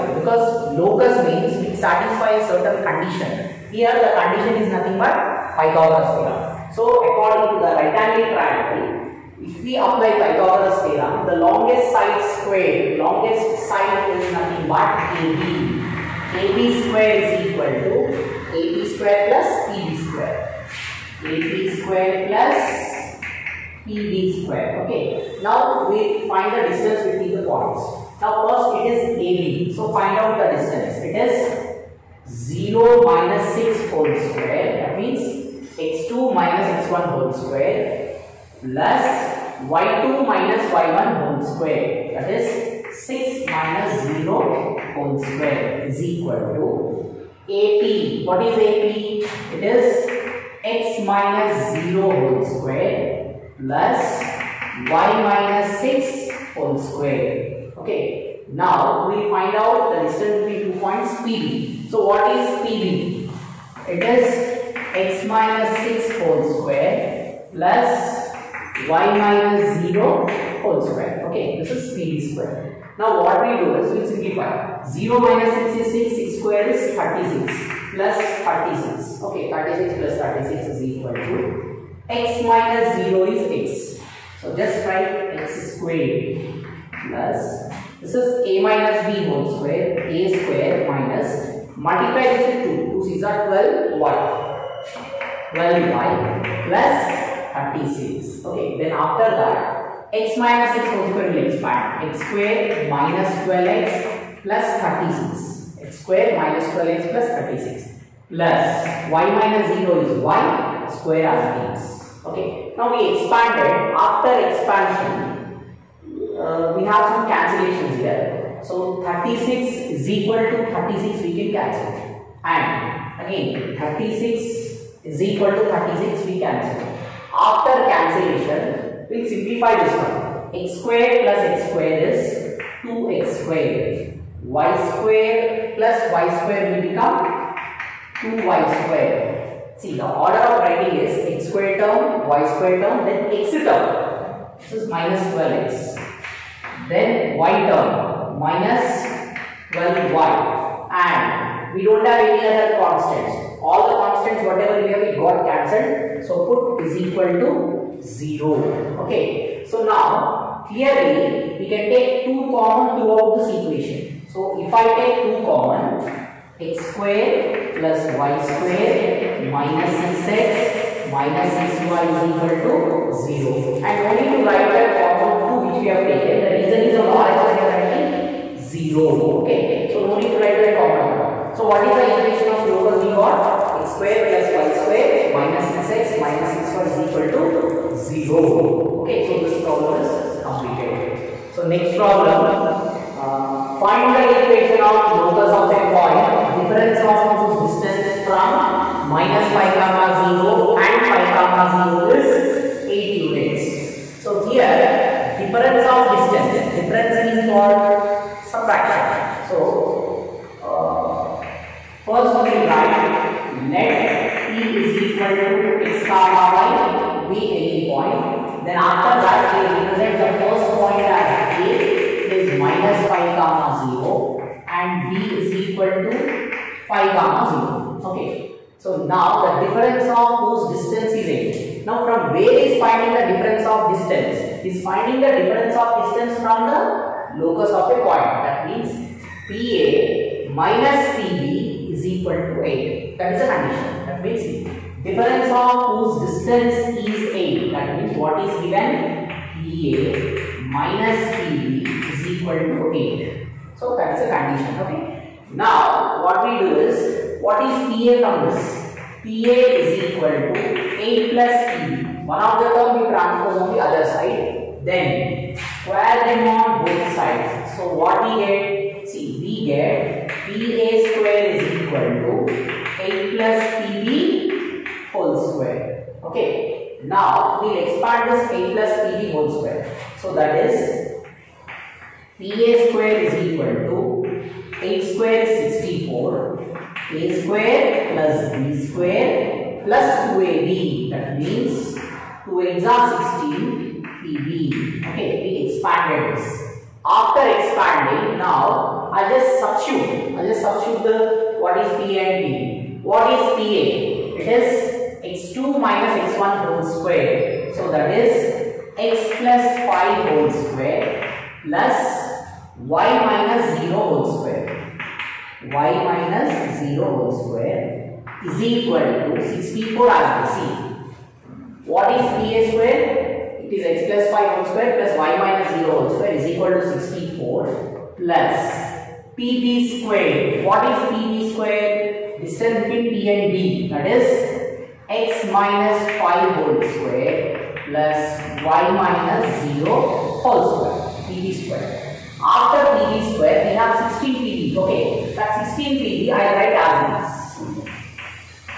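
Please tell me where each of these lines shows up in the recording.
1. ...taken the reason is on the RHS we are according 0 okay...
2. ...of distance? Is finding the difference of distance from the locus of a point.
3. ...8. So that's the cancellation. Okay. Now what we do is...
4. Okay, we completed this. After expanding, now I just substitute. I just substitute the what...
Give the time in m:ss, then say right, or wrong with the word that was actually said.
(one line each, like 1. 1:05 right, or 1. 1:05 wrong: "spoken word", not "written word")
1. 2:56 wrong: "writing", not "according"
2. 3:53 right
3. 4:12 wrong: "condition", not "cancellation"
4. 4:55 wrong: "expanded", not "completed".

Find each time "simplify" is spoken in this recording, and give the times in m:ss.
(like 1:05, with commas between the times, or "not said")
1:14, 2:09.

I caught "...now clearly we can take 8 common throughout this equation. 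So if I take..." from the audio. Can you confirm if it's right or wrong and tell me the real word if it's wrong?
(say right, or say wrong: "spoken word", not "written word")
wrong: "2", not "8".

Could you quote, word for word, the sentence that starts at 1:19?
Okay, 36 plus 36 is equal to x minus 0 is x.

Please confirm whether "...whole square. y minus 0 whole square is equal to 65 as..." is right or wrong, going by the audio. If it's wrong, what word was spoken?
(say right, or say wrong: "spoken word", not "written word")
wrong: "64", not "65".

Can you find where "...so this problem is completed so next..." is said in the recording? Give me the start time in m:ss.
3:09.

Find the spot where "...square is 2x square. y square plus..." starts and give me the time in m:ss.
2:11.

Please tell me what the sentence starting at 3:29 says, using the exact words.
So uh, first we write let P is equal to x comma y be any point.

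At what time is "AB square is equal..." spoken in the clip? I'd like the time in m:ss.
0:16.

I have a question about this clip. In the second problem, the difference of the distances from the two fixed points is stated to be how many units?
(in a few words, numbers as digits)
8.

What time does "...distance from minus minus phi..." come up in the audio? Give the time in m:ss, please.
3:17.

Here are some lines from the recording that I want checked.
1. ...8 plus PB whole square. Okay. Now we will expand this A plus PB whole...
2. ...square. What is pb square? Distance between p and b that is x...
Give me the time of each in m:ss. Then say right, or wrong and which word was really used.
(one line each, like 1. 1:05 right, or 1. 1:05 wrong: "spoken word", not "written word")
1. 4:33 right
2. 5:30 right.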